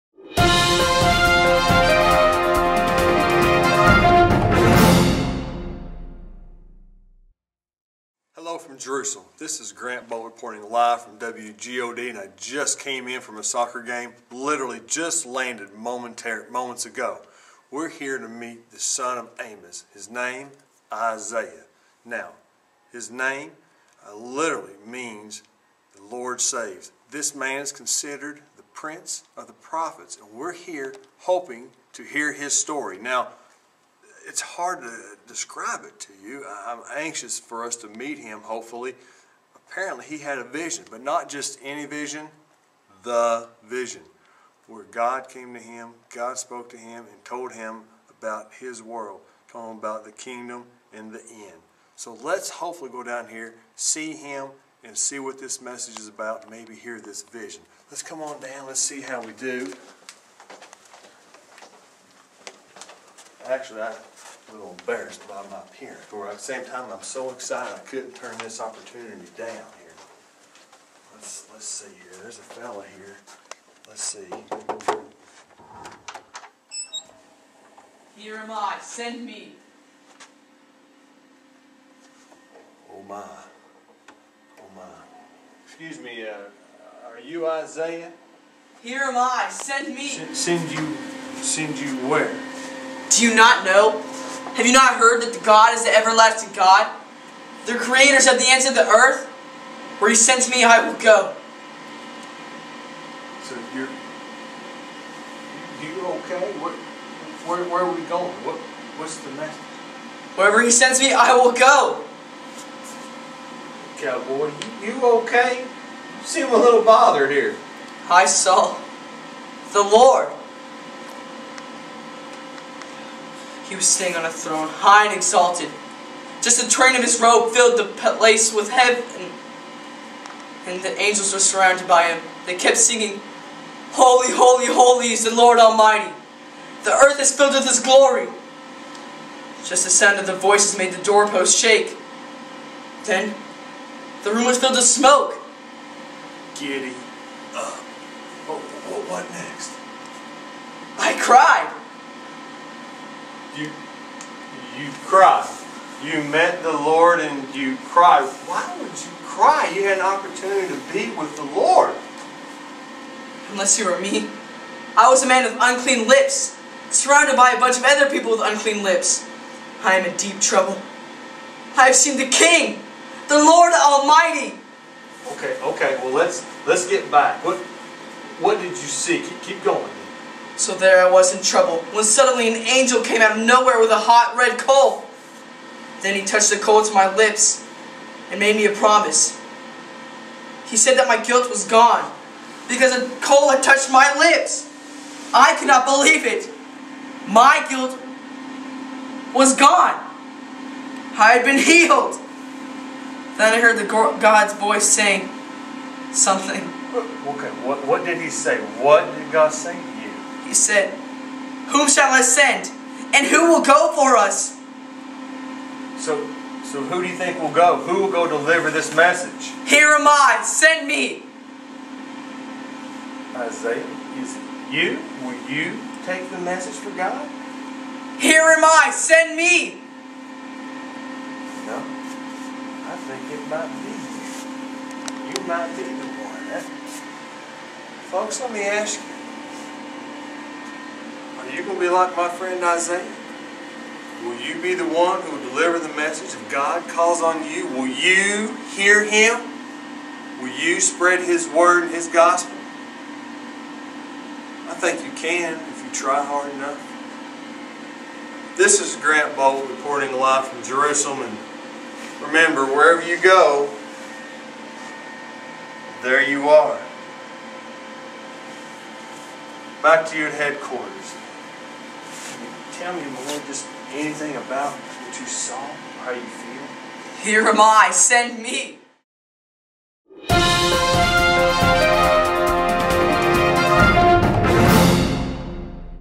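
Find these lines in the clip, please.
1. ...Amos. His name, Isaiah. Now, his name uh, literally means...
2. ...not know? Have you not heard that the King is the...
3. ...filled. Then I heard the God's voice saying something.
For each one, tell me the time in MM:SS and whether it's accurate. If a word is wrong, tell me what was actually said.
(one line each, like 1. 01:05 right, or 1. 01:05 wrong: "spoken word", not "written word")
1. 00:19 right
2. 01:33 wrong: "God", not "King"
3. 03:21 wrong: "healed", not "filled".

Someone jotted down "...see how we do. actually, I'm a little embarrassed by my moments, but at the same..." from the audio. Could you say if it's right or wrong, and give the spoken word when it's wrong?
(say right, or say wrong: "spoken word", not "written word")
wrong: "parents", not "moments".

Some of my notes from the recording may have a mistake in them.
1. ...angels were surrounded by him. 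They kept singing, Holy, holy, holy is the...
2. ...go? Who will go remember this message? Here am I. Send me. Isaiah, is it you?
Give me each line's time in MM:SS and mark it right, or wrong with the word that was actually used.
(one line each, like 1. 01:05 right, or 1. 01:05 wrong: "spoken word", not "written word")
1. 02:10 right
2. 03:37 wrong: "deliver", not "remember".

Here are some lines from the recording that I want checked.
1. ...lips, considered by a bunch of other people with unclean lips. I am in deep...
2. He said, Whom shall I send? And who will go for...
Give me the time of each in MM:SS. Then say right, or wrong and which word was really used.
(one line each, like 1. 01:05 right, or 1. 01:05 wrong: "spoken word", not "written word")
1. 02:46 wrong: "surrounded", not "considered"
2. 03:30 right.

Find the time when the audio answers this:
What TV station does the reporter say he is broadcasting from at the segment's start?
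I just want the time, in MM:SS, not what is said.
00:11.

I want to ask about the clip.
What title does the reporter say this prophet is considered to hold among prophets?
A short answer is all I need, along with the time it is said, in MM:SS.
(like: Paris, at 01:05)
Prince of the prophets, at 00:28.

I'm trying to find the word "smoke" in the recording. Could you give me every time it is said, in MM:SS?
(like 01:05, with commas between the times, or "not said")
02:24.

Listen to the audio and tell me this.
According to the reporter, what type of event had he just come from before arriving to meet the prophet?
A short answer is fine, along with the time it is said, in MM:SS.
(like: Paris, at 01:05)
Soccer game, at 00:13.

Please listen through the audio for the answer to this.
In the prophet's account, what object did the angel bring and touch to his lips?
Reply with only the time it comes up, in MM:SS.
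03:03.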